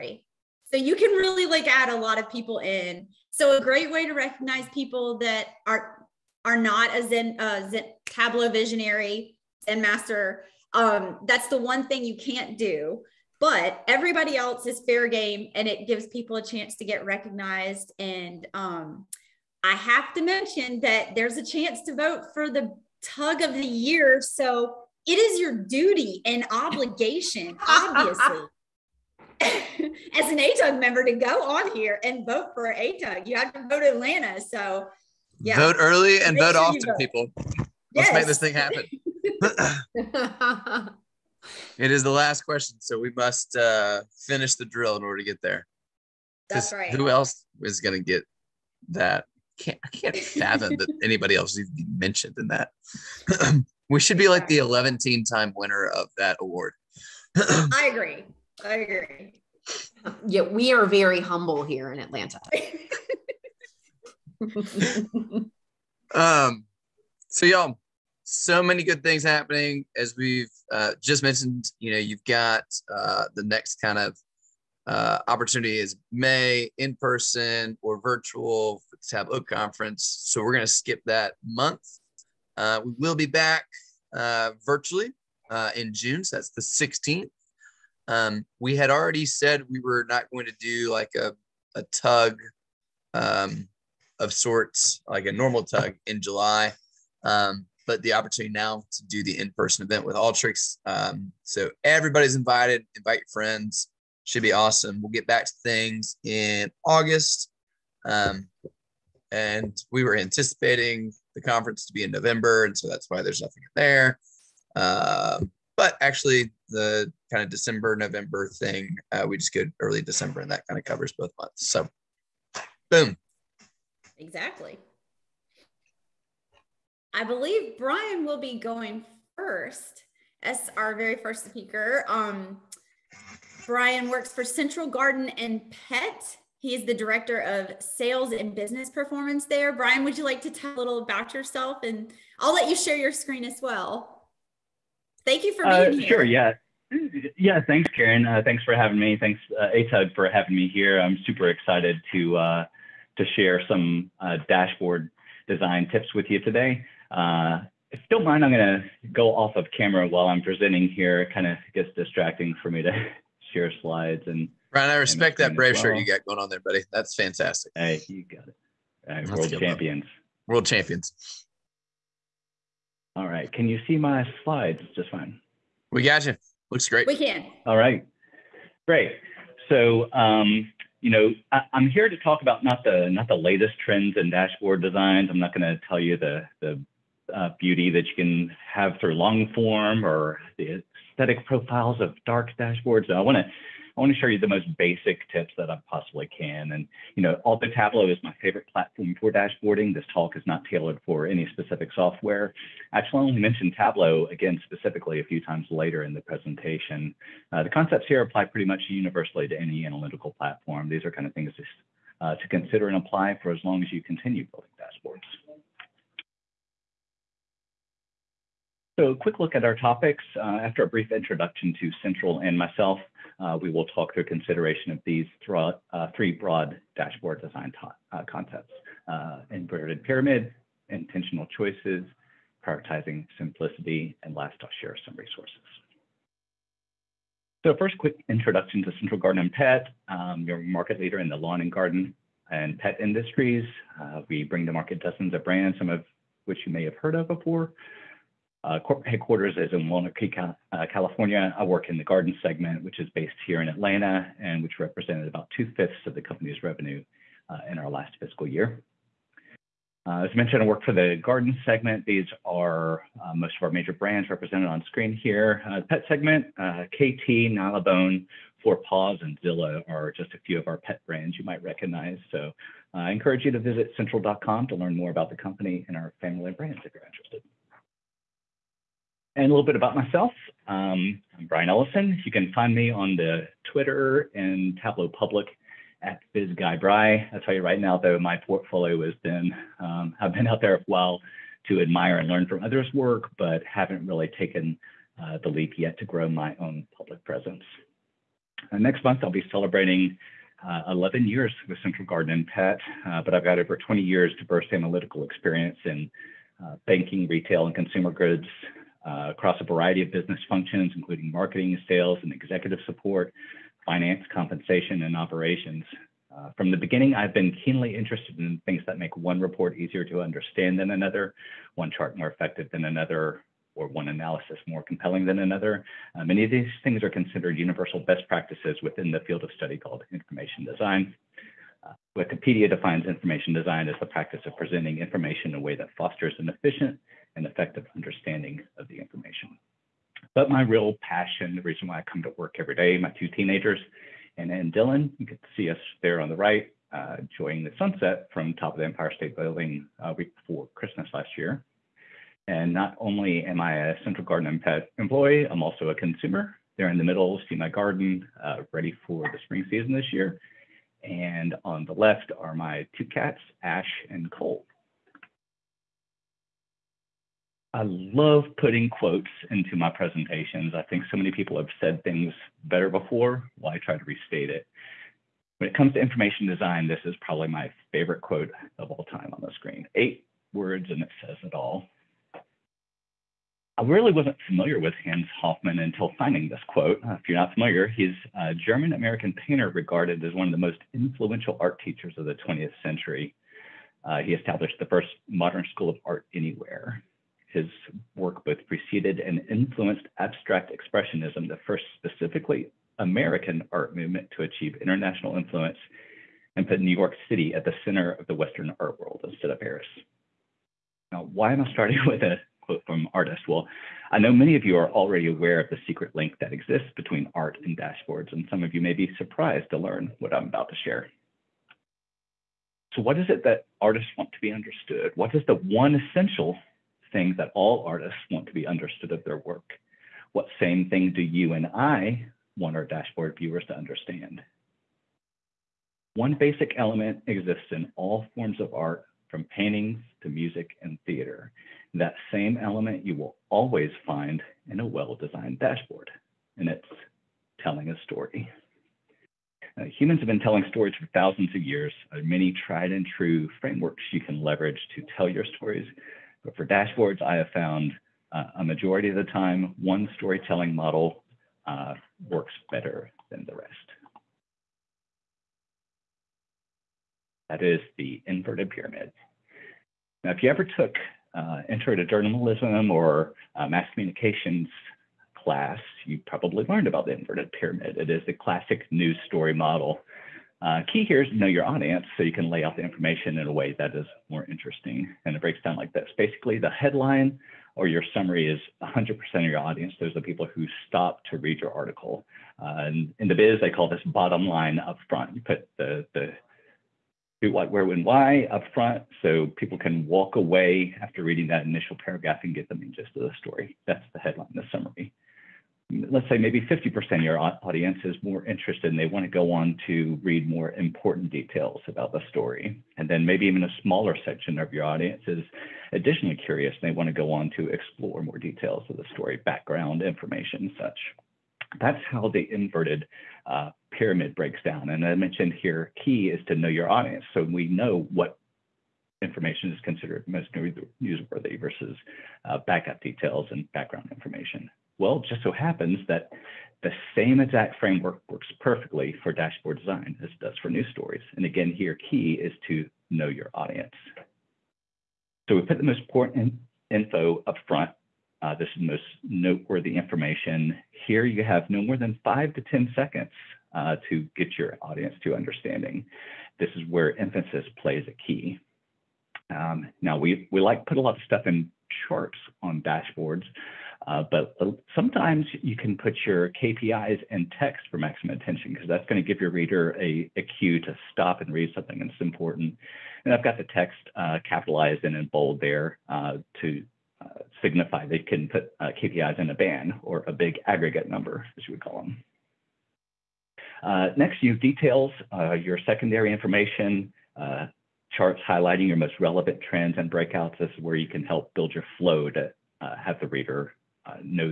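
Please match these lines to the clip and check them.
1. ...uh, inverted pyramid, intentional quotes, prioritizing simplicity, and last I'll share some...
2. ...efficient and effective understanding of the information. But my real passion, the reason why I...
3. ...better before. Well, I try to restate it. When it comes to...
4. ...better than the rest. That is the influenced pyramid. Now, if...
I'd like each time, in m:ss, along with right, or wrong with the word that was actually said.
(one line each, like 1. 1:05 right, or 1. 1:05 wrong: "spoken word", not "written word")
1. 3:49 wrong: "choices", not "quotes"
2. 5:36 right
3. 6:12 right
4. 7:42 wrong: "inverted", not "influenced".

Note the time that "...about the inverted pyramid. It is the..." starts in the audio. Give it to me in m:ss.
7:56.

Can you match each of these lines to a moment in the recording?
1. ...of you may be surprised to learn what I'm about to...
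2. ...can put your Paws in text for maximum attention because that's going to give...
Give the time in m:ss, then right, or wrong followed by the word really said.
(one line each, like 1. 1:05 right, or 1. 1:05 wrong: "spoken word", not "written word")
1. 6:58 right
2. 9:25 wrong: "KPIs", not "Paws".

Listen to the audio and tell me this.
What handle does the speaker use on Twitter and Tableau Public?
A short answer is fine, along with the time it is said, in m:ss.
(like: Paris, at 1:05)
BizGuyBry, at 4:46.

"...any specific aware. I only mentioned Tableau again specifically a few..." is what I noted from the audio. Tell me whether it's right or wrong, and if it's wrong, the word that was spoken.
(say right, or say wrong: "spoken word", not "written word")
wrong: "software", not "aware".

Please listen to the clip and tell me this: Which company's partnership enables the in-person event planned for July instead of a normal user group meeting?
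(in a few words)
Alteryx.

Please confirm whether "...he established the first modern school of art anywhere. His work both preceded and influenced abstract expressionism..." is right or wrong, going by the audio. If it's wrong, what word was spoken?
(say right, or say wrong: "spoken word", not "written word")
right.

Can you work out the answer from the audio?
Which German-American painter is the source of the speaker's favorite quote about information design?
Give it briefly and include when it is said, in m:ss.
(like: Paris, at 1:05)
Hans Hofmann, at 6:25.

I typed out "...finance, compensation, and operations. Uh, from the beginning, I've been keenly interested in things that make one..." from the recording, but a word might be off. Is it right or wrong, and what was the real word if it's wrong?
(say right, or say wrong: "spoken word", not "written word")
right.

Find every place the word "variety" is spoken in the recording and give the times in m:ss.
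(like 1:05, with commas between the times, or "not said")
5:09.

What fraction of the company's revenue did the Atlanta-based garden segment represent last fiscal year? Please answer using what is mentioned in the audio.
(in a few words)
Two-fifths.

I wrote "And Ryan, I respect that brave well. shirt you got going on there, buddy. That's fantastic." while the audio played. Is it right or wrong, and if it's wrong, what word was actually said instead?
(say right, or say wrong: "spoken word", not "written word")
right.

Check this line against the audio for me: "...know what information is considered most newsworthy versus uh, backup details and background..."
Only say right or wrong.
right.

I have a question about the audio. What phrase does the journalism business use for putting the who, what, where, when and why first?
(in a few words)
Bottom line up front.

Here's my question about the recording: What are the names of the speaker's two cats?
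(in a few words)
Ash and Cole.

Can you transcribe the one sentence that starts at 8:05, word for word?
And it breaks down like this.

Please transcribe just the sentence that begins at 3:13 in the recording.
So I want to I want to show you the most basic tips that I possibly can.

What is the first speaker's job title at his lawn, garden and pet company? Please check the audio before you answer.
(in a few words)
Director of sales and business performance.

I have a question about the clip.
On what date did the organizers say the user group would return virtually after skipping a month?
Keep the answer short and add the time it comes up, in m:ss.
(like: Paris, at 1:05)
June 16th, at 1:25.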